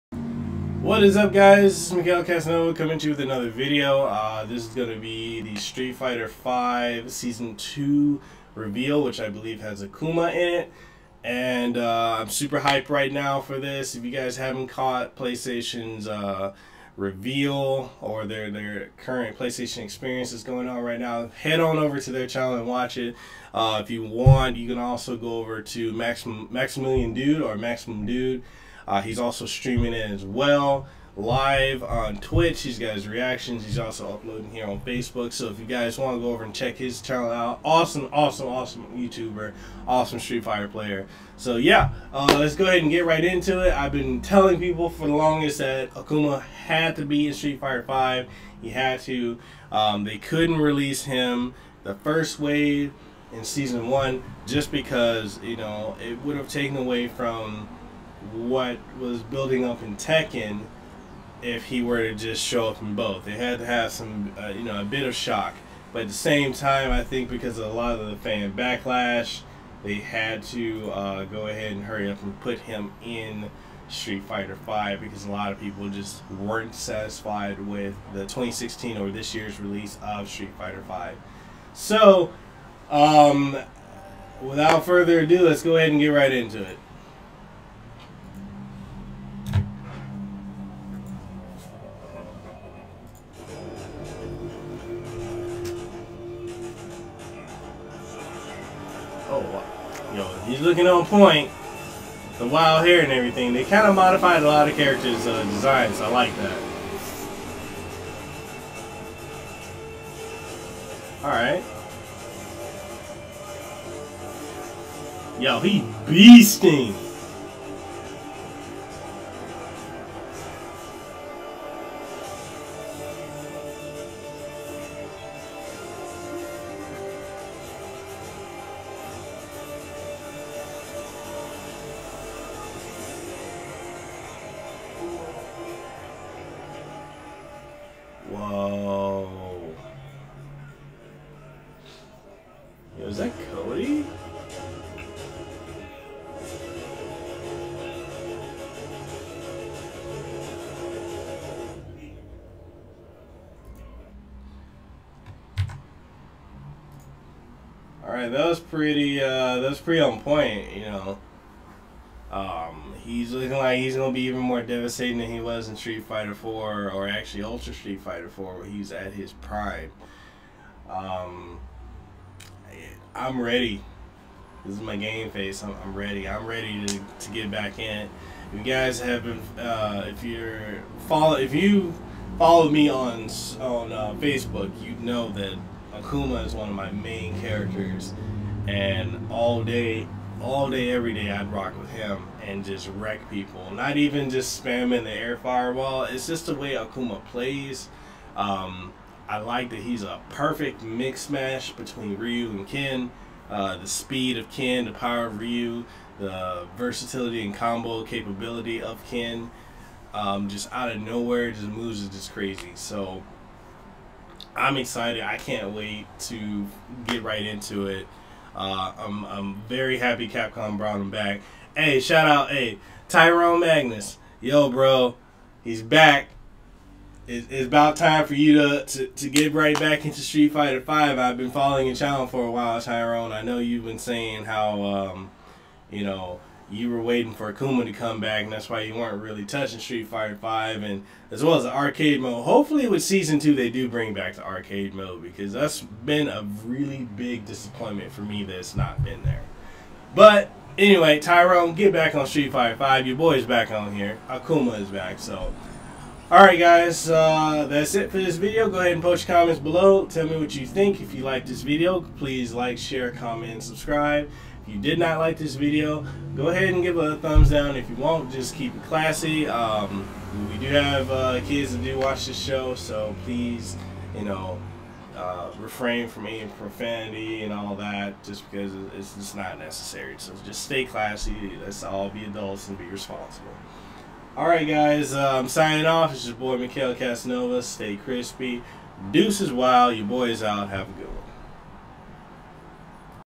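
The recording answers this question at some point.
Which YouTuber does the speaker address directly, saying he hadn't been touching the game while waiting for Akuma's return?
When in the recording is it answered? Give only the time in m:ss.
3:43.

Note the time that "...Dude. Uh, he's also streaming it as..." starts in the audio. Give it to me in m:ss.
0:28.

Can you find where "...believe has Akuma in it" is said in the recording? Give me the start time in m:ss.
0:09.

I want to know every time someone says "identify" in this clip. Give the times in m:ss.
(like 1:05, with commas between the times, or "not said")
not said.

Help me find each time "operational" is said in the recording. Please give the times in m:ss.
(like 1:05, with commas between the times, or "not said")
not said.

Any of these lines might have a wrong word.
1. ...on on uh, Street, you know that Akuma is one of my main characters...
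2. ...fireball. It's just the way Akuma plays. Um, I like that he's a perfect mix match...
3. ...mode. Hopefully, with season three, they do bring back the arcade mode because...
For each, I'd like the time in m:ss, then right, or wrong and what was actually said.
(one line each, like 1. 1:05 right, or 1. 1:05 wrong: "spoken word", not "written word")
1. 3:02 wrong: "Facebook", not "Street"
2. 3:15 right
3. 4:02 wrong: "two", not "three".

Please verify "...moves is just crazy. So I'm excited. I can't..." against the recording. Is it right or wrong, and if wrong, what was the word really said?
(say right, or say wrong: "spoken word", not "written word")
right.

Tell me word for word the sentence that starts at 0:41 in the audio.
So yeah, uh, let's go ahead and get right into it.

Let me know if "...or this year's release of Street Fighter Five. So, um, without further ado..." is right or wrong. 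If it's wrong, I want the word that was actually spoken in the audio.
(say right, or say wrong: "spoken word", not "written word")
right.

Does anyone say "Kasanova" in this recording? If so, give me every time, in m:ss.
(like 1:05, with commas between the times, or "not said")
0:02, 4:46.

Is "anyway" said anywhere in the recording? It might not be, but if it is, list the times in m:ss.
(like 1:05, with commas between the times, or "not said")
4:10.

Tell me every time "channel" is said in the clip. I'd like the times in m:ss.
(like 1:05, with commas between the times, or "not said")
0:22, 0:37, 3:51.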